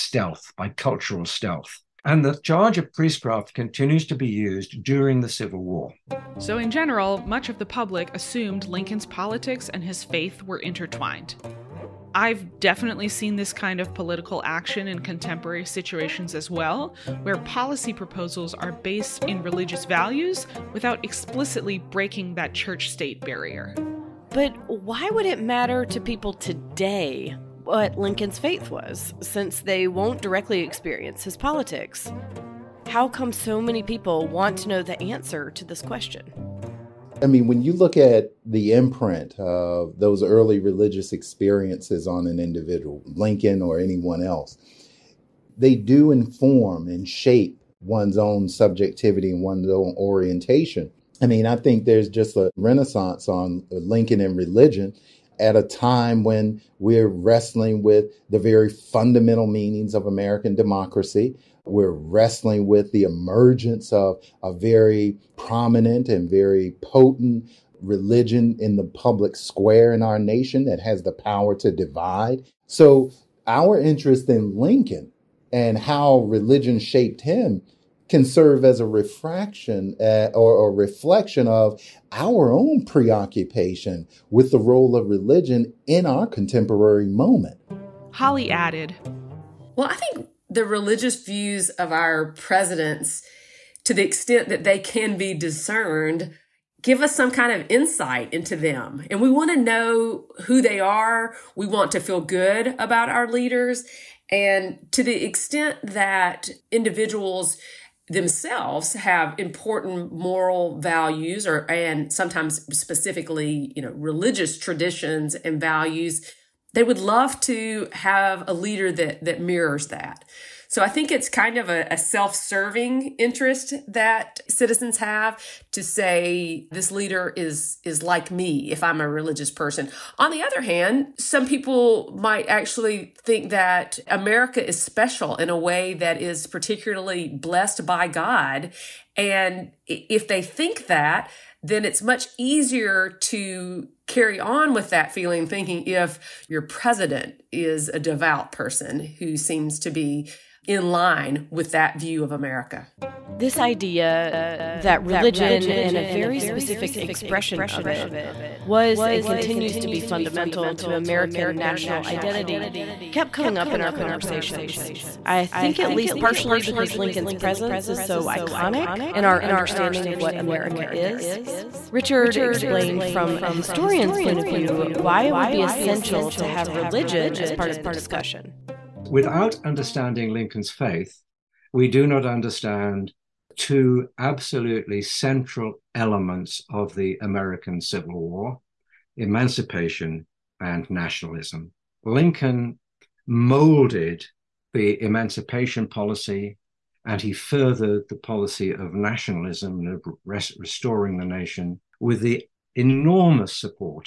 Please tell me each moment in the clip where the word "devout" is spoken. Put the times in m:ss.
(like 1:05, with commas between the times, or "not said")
2:27.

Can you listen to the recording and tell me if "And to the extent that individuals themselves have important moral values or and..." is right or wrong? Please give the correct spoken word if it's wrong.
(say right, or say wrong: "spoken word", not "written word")
right.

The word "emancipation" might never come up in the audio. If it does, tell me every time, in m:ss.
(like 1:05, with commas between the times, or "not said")
3:09, 3:15.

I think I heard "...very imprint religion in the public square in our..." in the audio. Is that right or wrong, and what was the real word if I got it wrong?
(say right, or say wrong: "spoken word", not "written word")
wrong: "potent", not "imprint".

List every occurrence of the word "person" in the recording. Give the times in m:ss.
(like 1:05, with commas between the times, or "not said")
2:09, 2:28.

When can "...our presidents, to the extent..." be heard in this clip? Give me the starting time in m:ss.
1:31.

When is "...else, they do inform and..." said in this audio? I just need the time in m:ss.
0:44.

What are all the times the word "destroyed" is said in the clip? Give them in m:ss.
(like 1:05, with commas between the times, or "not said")
not said.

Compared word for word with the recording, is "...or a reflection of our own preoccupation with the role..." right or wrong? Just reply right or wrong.
right.